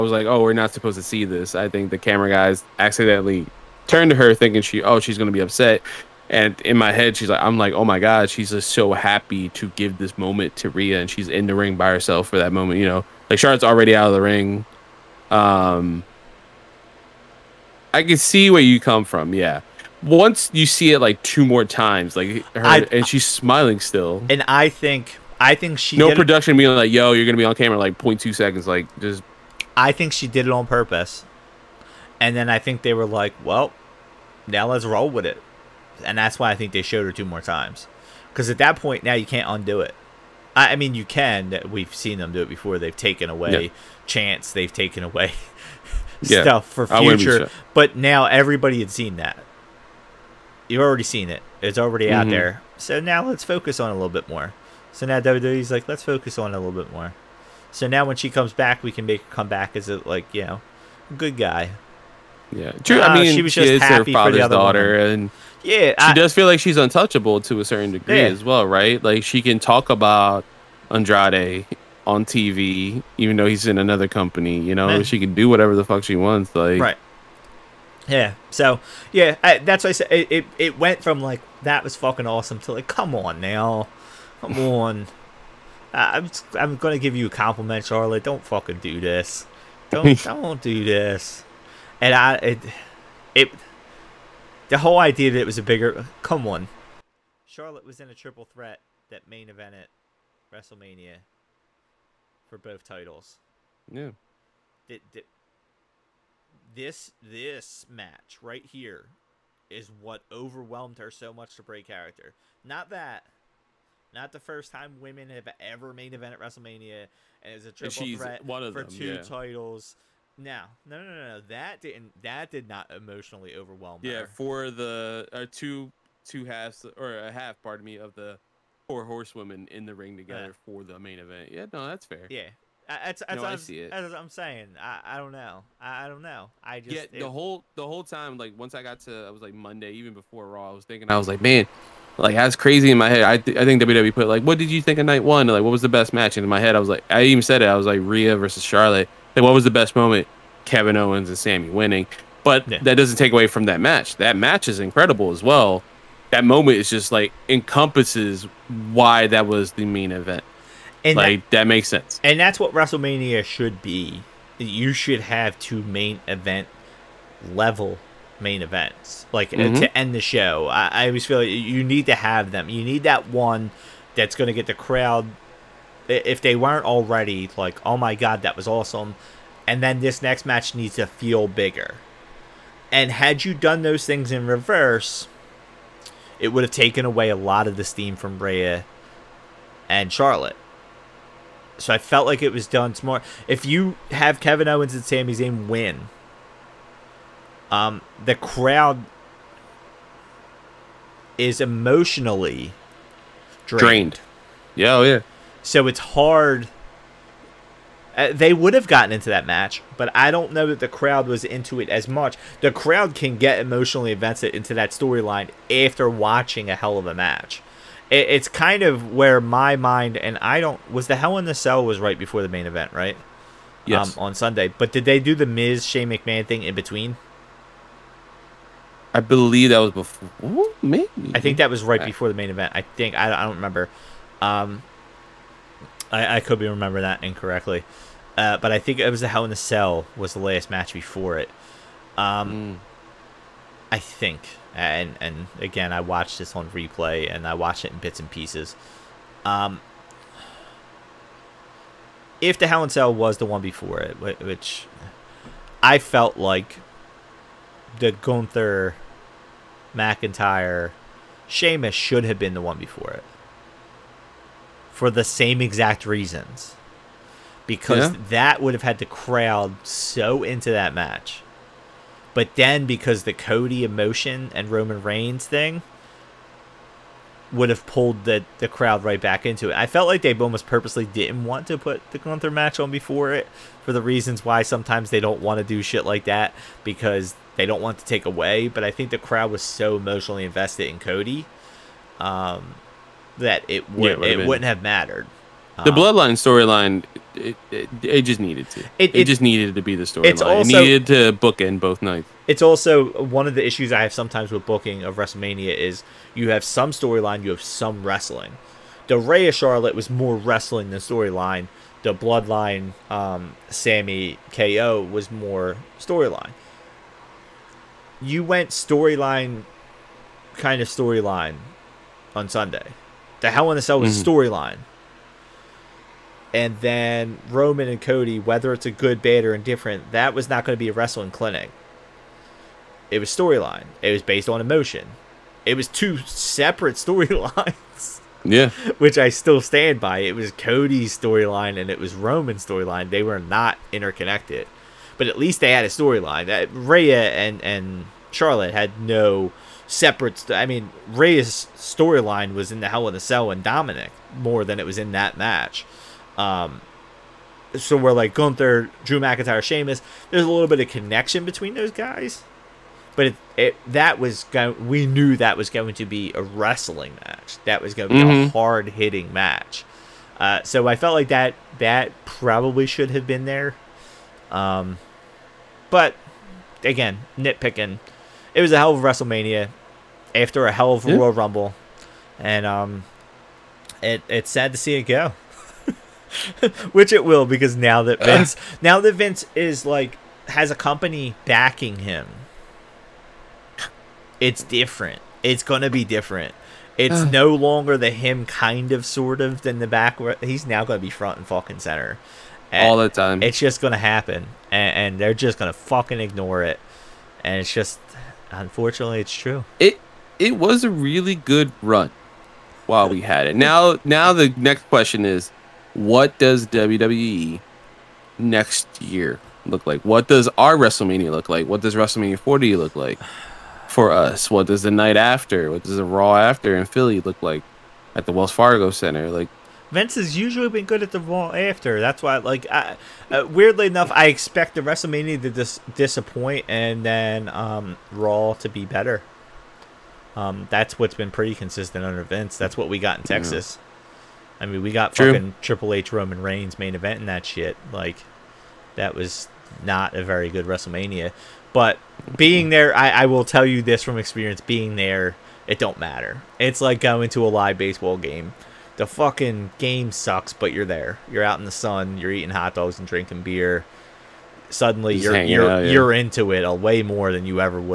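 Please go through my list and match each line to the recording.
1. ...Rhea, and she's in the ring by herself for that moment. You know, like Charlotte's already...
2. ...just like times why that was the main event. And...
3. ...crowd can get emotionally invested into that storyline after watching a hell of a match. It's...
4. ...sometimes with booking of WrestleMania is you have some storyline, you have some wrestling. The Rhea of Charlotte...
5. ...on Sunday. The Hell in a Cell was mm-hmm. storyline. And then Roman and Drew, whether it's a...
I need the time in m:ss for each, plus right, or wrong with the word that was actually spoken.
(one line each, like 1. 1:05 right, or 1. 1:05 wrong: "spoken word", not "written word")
1. 0:10 right
2. 2:36 wrong: "encompasses", not "times"
3. 3:32 right
4. 5:04 right
5. 5:22 wrong: "Cody", not "Drew".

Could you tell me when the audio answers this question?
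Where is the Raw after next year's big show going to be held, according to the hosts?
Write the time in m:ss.
7:08.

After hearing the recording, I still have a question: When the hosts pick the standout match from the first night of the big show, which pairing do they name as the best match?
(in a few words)
Rhea versus Charlotte.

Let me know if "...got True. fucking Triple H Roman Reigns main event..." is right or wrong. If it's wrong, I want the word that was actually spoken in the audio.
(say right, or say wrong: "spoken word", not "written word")
right.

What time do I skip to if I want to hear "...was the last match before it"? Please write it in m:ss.
4:00.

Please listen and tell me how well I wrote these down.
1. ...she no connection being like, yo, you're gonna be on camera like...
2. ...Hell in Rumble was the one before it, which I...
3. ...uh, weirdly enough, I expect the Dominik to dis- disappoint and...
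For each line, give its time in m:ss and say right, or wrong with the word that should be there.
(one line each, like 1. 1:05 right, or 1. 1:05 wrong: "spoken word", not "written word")
1. 0:25 wrong: "production", not "connection"
2. 4:12 wrong: "Cell", not "Rumble"
3. 7:13 wrong: "WrestleMania", not "Dominik".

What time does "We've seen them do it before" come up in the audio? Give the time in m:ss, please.
0:41.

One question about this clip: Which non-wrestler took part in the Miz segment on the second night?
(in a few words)
Shane McMahon.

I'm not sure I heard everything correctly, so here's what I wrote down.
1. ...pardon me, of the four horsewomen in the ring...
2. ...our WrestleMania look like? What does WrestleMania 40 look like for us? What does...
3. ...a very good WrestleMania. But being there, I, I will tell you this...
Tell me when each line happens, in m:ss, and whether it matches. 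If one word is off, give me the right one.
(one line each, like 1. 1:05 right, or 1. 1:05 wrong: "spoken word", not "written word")
1. 2:07 right
2. 7:00 right
3. 7:30 right.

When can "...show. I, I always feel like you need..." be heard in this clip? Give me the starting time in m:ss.
2:50.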